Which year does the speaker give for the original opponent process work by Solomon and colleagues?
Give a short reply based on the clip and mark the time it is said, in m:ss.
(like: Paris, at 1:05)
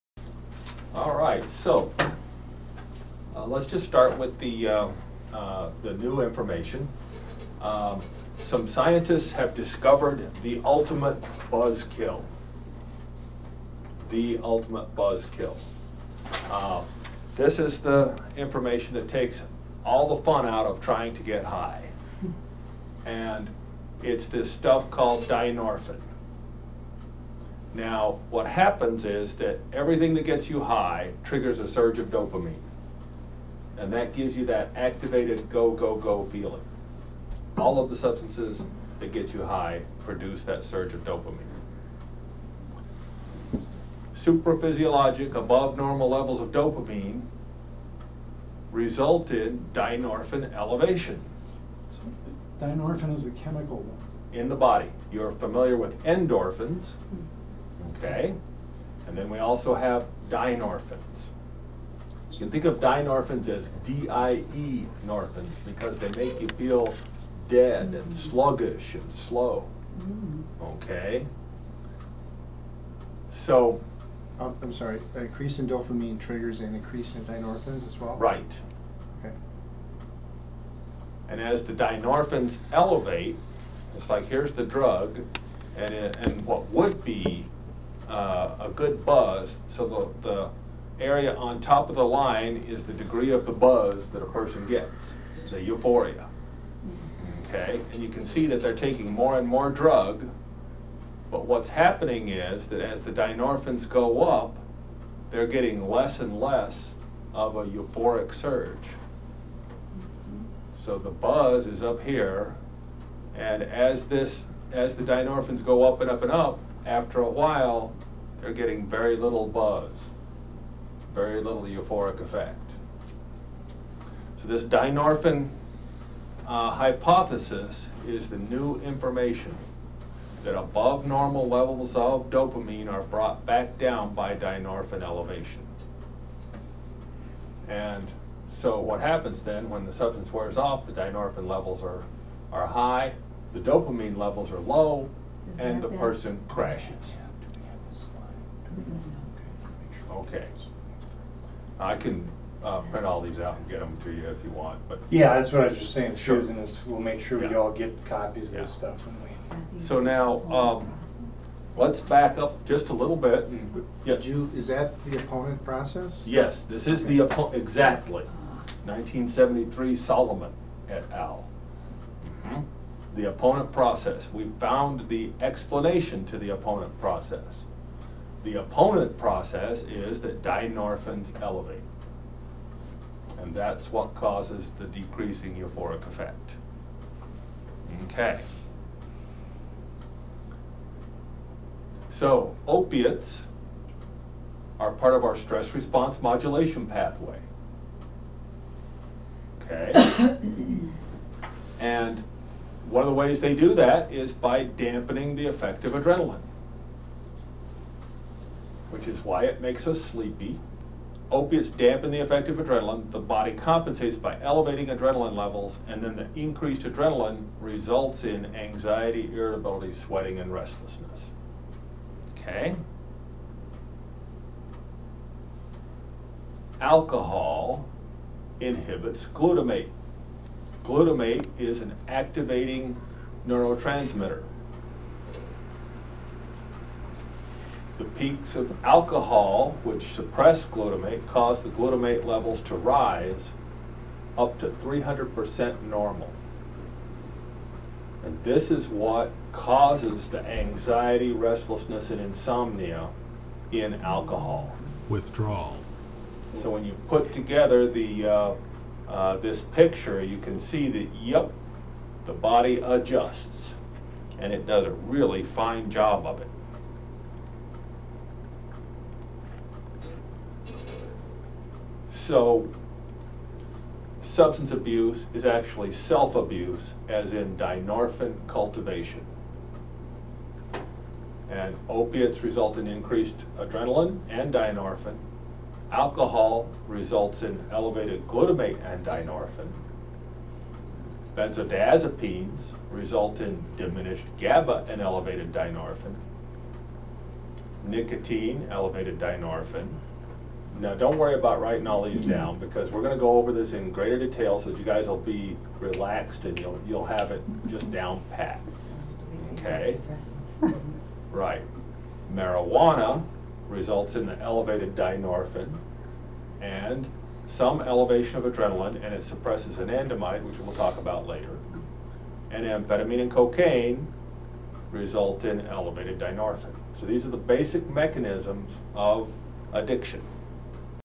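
1973, at 2:48.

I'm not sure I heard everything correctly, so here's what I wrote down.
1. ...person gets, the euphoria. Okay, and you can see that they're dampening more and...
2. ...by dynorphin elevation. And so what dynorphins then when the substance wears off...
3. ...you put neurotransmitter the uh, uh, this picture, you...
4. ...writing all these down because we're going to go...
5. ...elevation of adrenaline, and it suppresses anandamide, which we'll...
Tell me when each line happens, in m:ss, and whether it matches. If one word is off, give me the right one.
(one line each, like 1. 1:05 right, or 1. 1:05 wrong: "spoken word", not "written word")
1. 1:34 wrong: "taking", not "dampening"
2. 2:14 wrong: "happens", not "dynorphins"
3. 4:16 wrong: "together", not "neurotransmitter"
4. 5:01 right
5. 5:17 right.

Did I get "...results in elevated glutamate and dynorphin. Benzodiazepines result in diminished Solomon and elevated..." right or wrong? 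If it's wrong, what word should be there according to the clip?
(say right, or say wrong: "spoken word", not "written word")
wrong: "GABA", not "Solomon".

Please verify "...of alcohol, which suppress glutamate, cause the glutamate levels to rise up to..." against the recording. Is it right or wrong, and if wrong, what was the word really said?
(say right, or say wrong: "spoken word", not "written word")
right.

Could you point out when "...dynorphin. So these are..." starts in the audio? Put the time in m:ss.
5:26.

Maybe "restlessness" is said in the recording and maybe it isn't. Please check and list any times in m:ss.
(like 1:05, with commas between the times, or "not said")
3:40, 4:11.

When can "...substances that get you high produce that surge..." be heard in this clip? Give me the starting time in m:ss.
0:37.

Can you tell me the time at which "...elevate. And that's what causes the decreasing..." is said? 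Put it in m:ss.
3:01.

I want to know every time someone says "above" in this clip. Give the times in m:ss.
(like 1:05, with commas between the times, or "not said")
0:45, 2:10.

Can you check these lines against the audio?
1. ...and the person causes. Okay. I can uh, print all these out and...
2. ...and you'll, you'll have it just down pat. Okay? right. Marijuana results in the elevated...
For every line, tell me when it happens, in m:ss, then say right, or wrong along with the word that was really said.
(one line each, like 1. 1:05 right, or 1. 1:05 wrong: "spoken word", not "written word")
1. 2:25 wrong: "crashes", not "causes"
2. 5:06 right.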